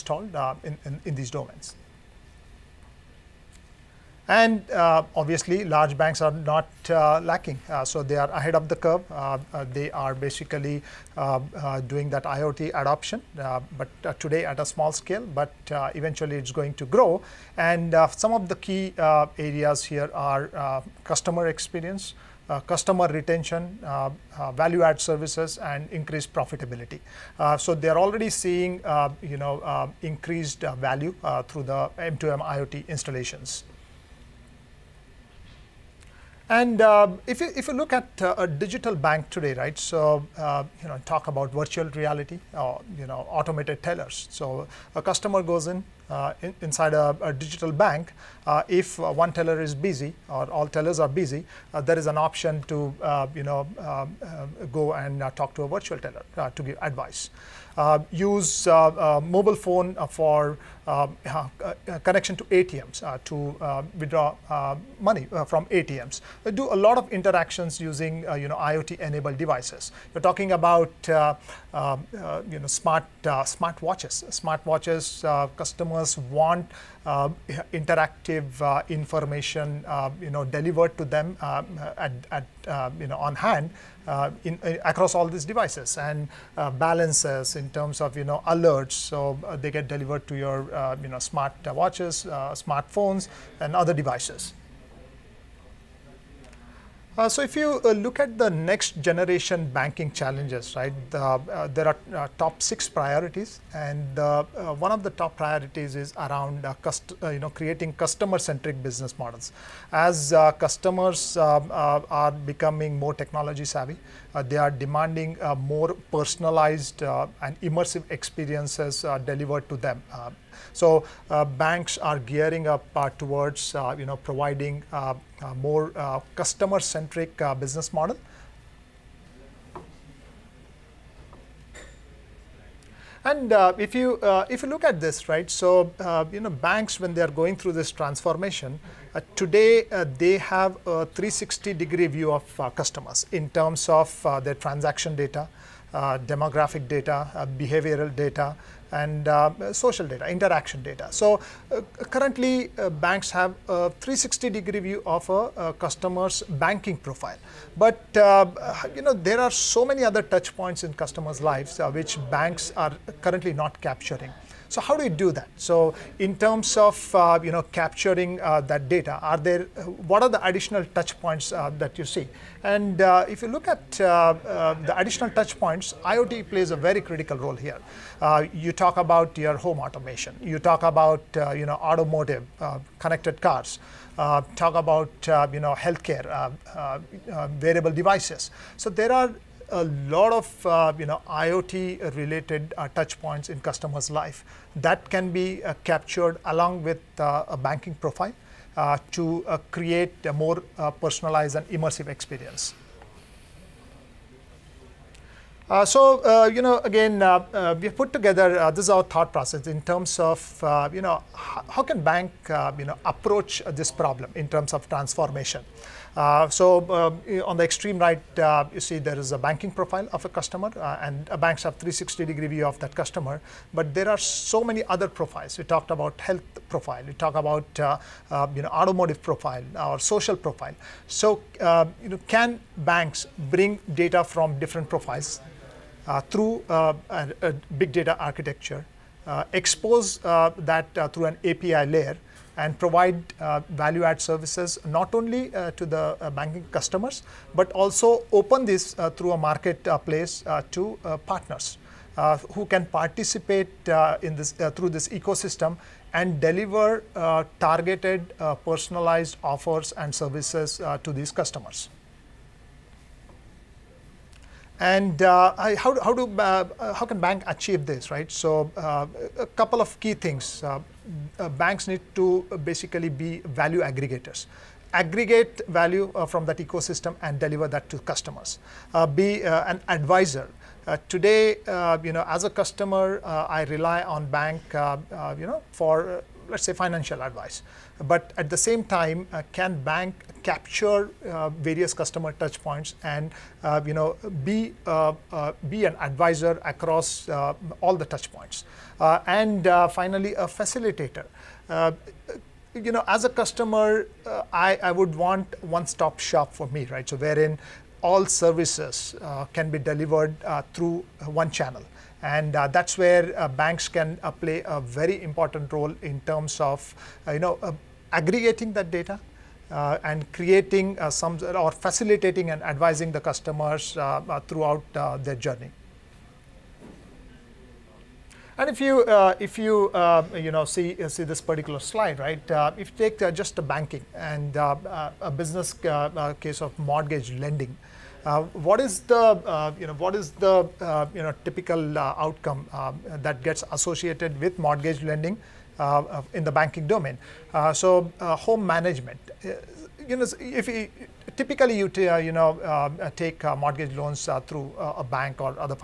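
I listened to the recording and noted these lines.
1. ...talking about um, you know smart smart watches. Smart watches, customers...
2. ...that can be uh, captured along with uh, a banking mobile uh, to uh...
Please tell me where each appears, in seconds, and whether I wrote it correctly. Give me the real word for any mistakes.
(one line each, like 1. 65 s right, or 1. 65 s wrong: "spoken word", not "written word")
1. 70 s right
2. 194 s wrong: "profile", not "mobile".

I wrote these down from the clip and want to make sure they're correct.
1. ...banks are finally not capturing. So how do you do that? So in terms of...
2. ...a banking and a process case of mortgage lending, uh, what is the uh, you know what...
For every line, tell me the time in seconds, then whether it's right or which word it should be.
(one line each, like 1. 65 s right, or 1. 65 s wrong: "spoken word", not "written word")
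1. 162 s wrong: "currently", not "finally"
2. 333 s wrong: "business", not "process".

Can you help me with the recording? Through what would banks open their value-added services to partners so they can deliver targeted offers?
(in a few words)
A marketplace.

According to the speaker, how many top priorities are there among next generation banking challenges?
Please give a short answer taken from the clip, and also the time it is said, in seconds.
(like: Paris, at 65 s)
6, at 102 s.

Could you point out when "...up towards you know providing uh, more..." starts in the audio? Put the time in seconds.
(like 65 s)
122 s.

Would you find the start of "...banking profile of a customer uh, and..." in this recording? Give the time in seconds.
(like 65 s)
219 s.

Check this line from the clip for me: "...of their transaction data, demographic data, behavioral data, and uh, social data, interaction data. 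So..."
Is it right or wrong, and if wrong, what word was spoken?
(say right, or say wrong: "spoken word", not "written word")
right.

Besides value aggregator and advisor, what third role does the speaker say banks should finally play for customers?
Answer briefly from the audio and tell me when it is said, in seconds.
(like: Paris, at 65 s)
Facilitator, at 300 s.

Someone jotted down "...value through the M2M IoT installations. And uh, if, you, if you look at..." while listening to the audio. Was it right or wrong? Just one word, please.
right.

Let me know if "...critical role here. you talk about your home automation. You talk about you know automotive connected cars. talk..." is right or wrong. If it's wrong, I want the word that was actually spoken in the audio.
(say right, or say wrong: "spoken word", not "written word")
right.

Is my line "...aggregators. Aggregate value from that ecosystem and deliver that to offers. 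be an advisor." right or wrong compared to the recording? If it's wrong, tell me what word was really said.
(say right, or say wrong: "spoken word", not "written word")
wrong: "customers", not "offers".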